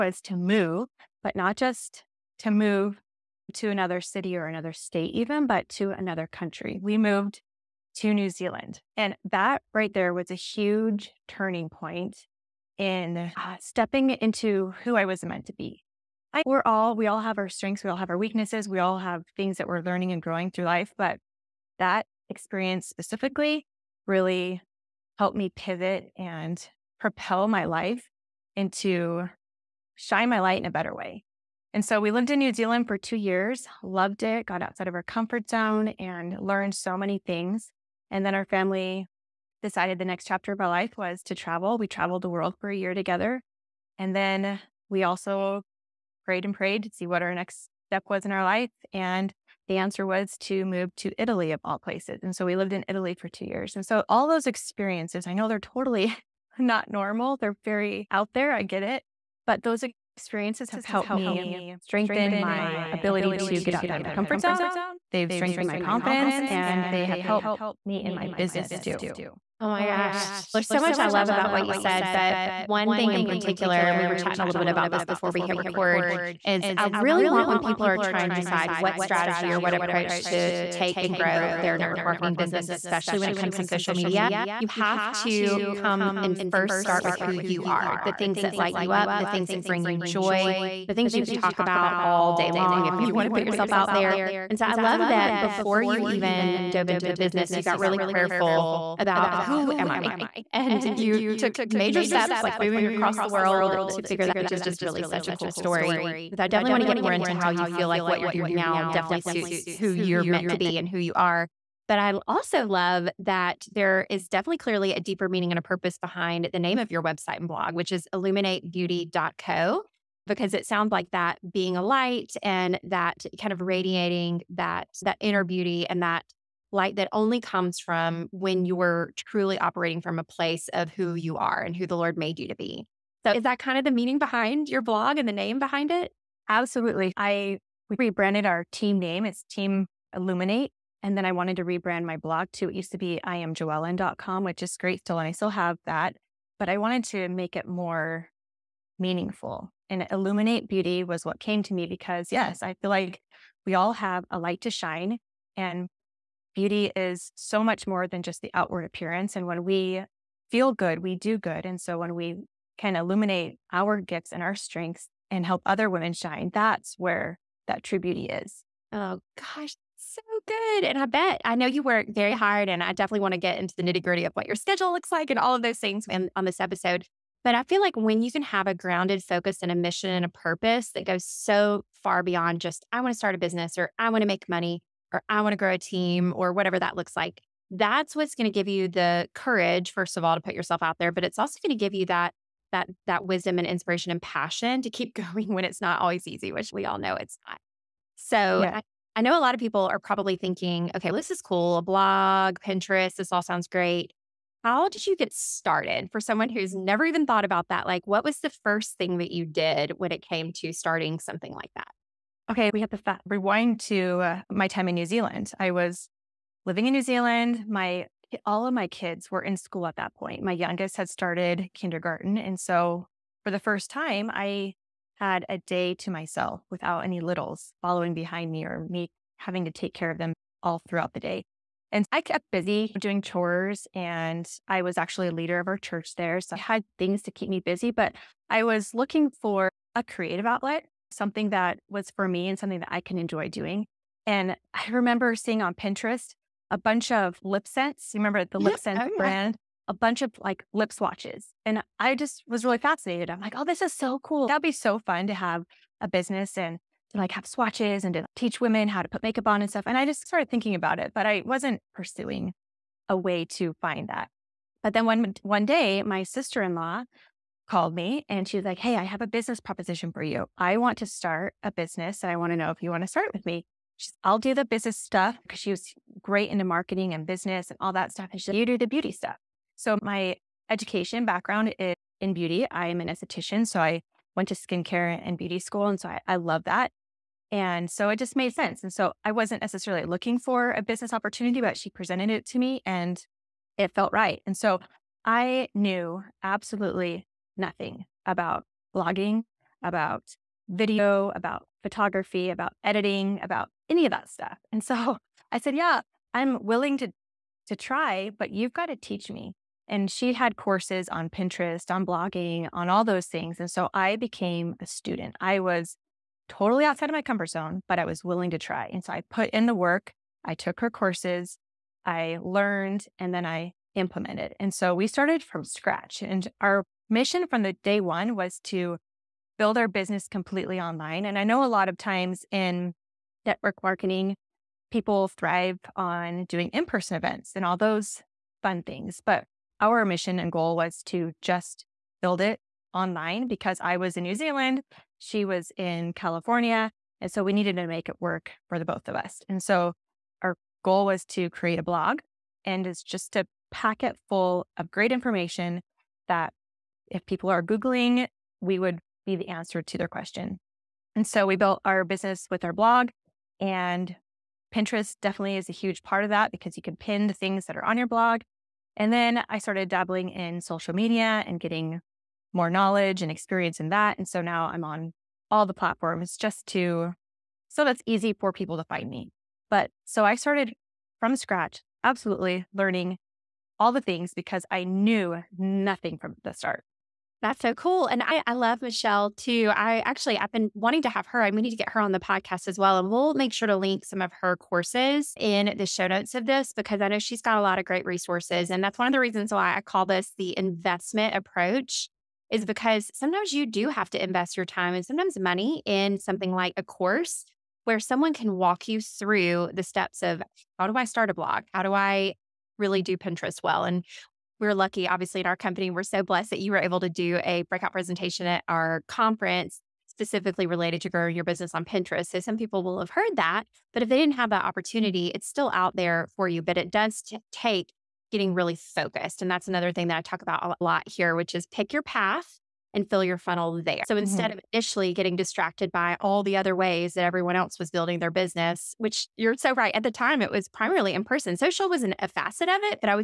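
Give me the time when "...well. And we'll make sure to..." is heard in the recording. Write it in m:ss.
6:32.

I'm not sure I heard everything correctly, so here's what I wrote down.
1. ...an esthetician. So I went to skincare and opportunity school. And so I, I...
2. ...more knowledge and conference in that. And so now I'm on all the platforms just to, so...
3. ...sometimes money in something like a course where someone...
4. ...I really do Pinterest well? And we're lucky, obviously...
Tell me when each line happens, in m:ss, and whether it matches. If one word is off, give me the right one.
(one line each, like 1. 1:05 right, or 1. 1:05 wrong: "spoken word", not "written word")
1. 4:43 wrong: "beauty", not "opportunity"
2. 6:12 wrong: "experience", not "conference"
3. 6:45 right
4. 6:51 right.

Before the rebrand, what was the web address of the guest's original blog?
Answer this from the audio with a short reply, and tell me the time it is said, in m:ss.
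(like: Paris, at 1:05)
iamjoellen.com, at 2:23.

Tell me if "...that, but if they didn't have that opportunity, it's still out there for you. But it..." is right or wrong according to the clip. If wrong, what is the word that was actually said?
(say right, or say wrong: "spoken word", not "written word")
right.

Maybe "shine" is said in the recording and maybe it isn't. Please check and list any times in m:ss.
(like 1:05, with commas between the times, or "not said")
0:29, 2:34, 2:46.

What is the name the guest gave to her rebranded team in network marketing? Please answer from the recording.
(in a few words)
Team Illuminate.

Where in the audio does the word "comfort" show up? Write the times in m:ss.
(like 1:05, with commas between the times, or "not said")
0:35, 1:04, 5:17.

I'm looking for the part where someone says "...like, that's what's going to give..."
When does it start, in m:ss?
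3:07.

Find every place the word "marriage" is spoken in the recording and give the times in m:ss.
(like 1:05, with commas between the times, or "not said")
not said.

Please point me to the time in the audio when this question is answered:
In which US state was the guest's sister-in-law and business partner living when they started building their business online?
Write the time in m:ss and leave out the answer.
5:46.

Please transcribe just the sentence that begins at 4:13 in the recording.
I'm like, oh, this is so cool.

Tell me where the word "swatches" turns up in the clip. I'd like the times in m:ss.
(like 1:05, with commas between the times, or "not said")
4:10, 4:17.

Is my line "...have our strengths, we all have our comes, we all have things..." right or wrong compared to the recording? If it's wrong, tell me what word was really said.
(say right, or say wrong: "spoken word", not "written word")
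wrong: "weaknesses", not "comes".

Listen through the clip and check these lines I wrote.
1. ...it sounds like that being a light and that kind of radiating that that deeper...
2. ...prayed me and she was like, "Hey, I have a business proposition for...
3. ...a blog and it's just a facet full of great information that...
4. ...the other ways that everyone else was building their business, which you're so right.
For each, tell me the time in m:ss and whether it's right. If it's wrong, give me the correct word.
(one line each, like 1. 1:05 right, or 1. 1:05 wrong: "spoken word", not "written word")
1. 2:00 wrong: "inner", not "deeper"
2. 4:27 wrong: "called", not "prayed"
3. 5:51 wrong: "packet", not "facet"
4. 7:16 right.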